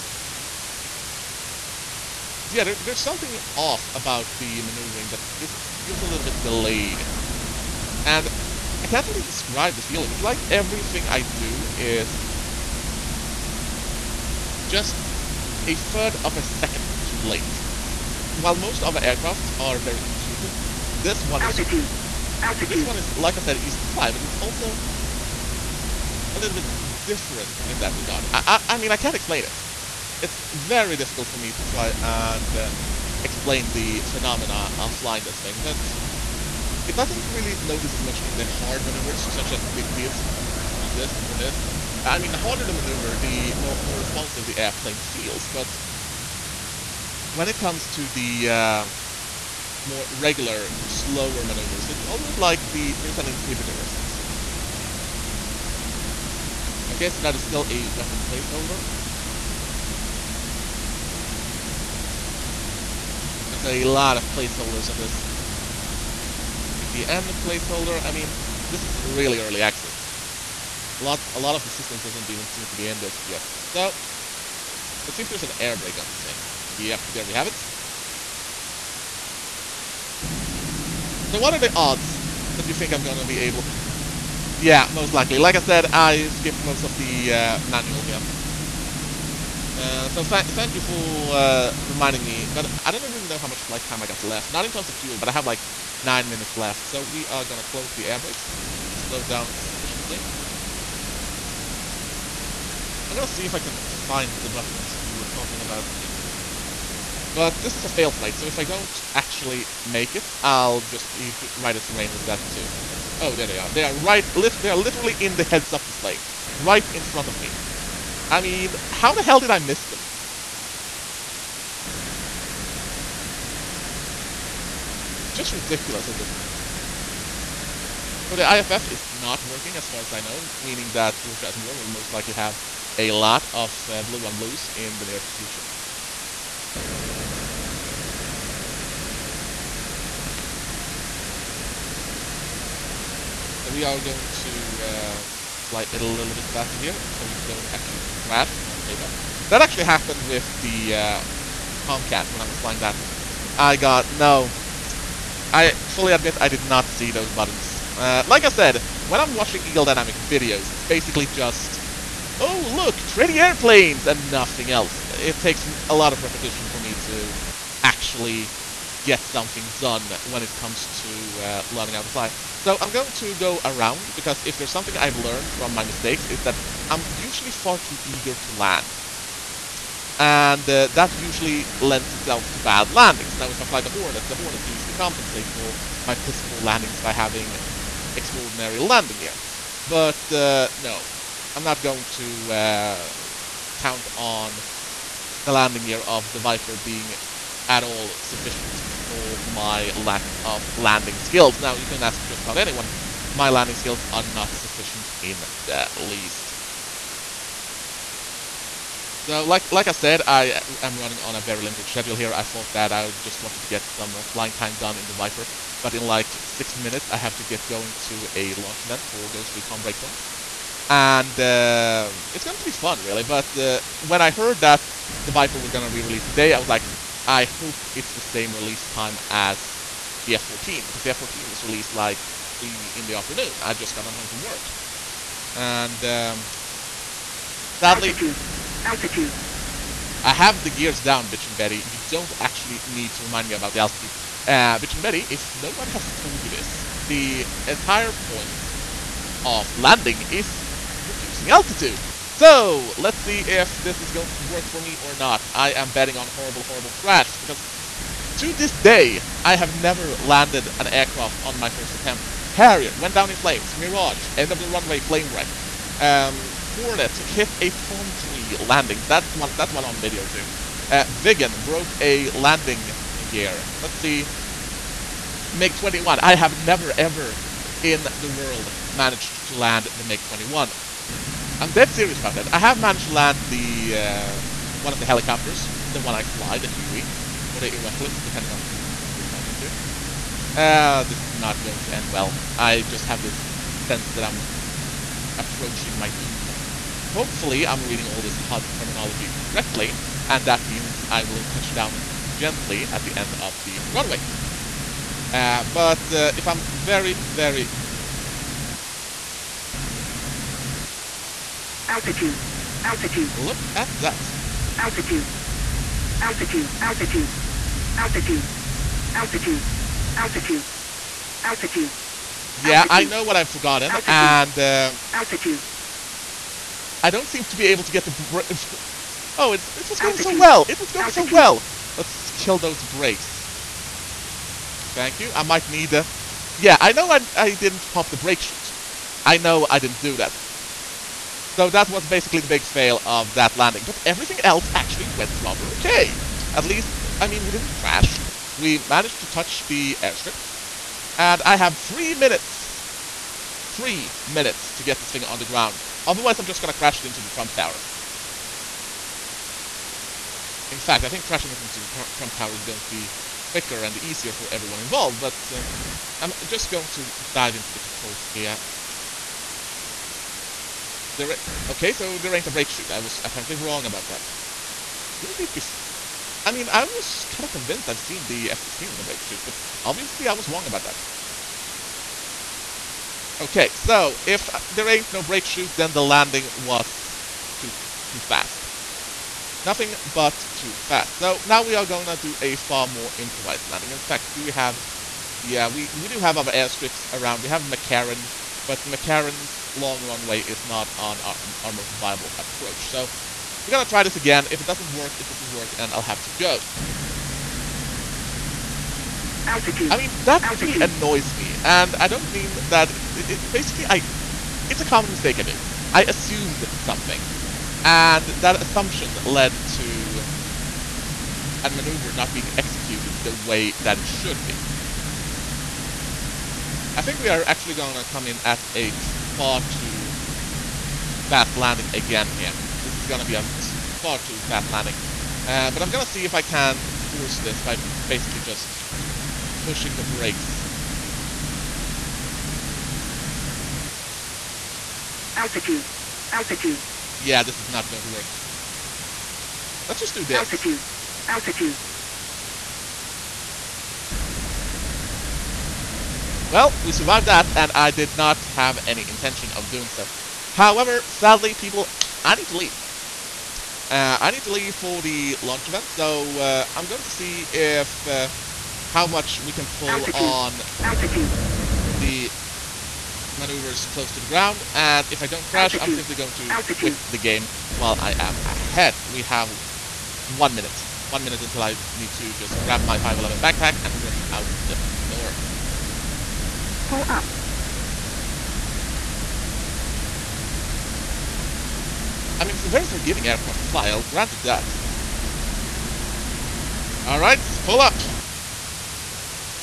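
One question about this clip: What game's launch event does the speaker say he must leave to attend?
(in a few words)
Ghost Recon Breakpoint.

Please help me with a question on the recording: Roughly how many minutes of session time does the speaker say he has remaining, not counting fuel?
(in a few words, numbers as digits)
9.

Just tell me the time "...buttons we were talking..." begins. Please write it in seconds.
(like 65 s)
104 s.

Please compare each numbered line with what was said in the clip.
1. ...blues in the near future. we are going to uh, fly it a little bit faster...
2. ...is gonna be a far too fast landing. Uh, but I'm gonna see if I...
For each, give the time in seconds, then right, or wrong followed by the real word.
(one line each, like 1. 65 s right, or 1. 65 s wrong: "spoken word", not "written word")
1. 134 s right
2. 433 s right.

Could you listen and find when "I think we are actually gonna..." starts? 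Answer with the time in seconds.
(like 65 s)
426 s.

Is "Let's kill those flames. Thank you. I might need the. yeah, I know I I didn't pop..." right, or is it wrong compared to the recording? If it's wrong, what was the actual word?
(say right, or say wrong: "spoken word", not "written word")
wrong: "brakes", not "flames".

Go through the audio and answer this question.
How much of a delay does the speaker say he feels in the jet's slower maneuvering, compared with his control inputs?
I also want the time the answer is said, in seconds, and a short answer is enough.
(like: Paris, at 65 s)
A third of a second, at 15 s.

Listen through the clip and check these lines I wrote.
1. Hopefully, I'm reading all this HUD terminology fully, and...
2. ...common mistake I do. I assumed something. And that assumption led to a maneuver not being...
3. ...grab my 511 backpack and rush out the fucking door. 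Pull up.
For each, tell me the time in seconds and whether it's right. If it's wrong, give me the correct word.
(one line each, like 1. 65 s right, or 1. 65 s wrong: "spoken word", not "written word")
1. 297 s wrong: "correctly", not "fully"
2. 414 s right
3. 482 s right.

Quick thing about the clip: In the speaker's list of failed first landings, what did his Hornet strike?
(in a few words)
A palm tree.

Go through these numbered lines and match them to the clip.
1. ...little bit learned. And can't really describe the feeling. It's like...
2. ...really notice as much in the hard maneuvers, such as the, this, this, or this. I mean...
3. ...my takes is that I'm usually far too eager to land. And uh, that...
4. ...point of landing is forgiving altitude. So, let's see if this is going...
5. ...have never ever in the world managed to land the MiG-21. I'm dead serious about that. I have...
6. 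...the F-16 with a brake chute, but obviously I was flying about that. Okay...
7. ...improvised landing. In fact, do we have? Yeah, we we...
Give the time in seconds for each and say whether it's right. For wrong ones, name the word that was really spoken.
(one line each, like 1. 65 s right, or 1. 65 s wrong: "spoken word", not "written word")
1. 6 s wrong: "delayed", not "learned"
2. 37 s right
3. 175 s wrong: "mistakes", not "takes"
4. 248 s wrong: "reducing", not "forgiving"
5. 276 s right
6. 378 s wrong: "wrong", not "flying"
7. 393 s right.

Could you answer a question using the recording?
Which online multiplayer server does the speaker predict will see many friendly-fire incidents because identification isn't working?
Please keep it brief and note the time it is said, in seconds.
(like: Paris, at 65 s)
Georgia at War, at 131 s.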